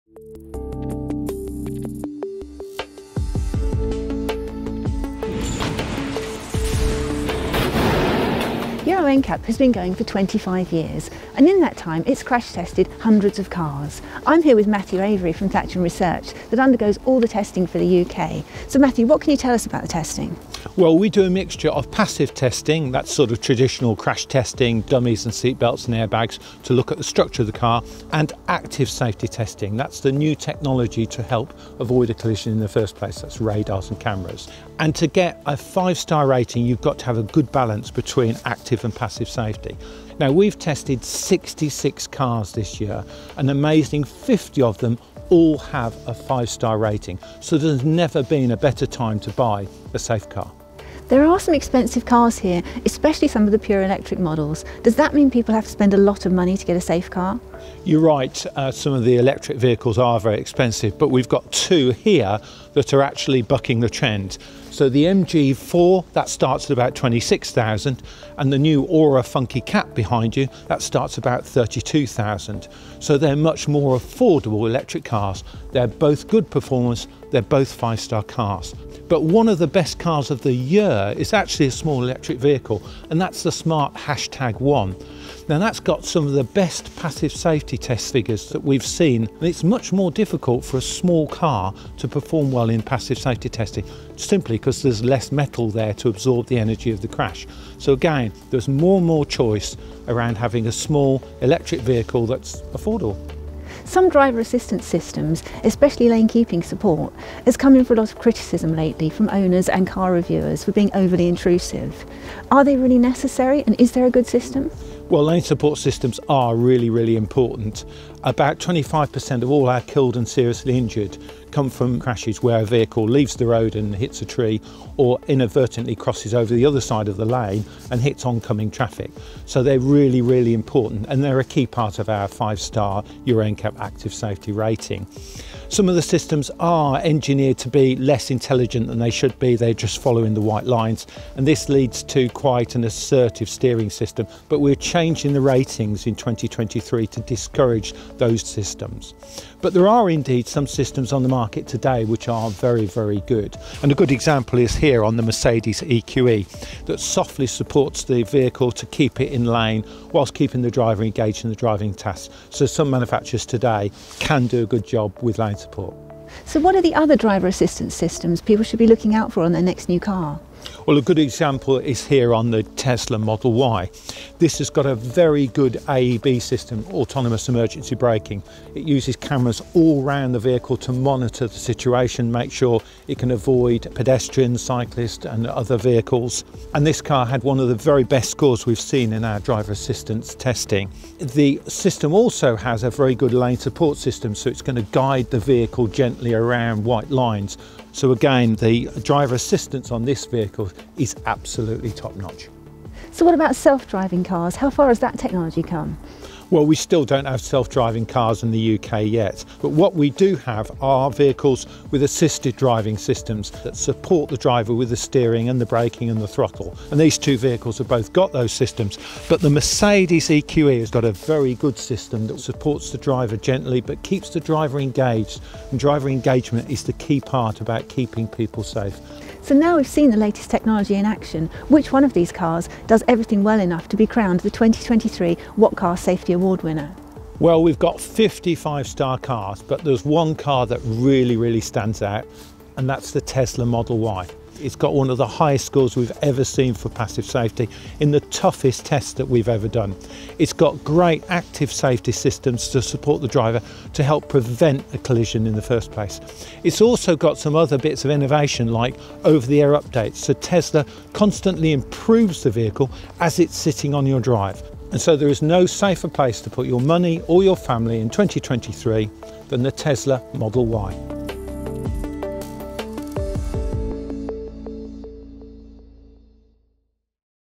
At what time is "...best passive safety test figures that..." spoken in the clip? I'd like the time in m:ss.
1:26.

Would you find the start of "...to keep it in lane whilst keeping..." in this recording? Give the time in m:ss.
2:38.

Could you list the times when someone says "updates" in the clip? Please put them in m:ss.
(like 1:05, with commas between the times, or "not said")
4:19.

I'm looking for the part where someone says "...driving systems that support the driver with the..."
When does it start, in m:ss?
3:32.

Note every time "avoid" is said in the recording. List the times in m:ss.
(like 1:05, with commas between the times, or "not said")
0:31, 3:03.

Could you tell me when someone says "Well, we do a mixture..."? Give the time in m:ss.
0:20.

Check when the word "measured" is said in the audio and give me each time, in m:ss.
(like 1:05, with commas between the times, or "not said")
not said.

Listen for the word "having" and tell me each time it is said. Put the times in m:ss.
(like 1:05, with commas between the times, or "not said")
1:40.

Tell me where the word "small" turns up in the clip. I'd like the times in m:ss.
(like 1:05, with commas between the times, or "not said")
1:21, 1:30, 1:40.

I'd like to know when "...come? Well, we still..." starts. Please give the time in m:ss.
3:25.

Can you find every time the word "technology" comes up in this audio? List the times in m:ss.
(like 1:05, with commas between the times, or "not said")
0:30, 3:25, 3:50.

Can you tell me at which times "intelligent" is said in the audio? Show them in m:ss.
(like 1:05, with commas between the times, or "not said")
2:18.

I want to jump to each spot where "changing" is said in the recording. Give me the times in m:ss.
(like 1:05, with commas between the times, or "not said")
2:24.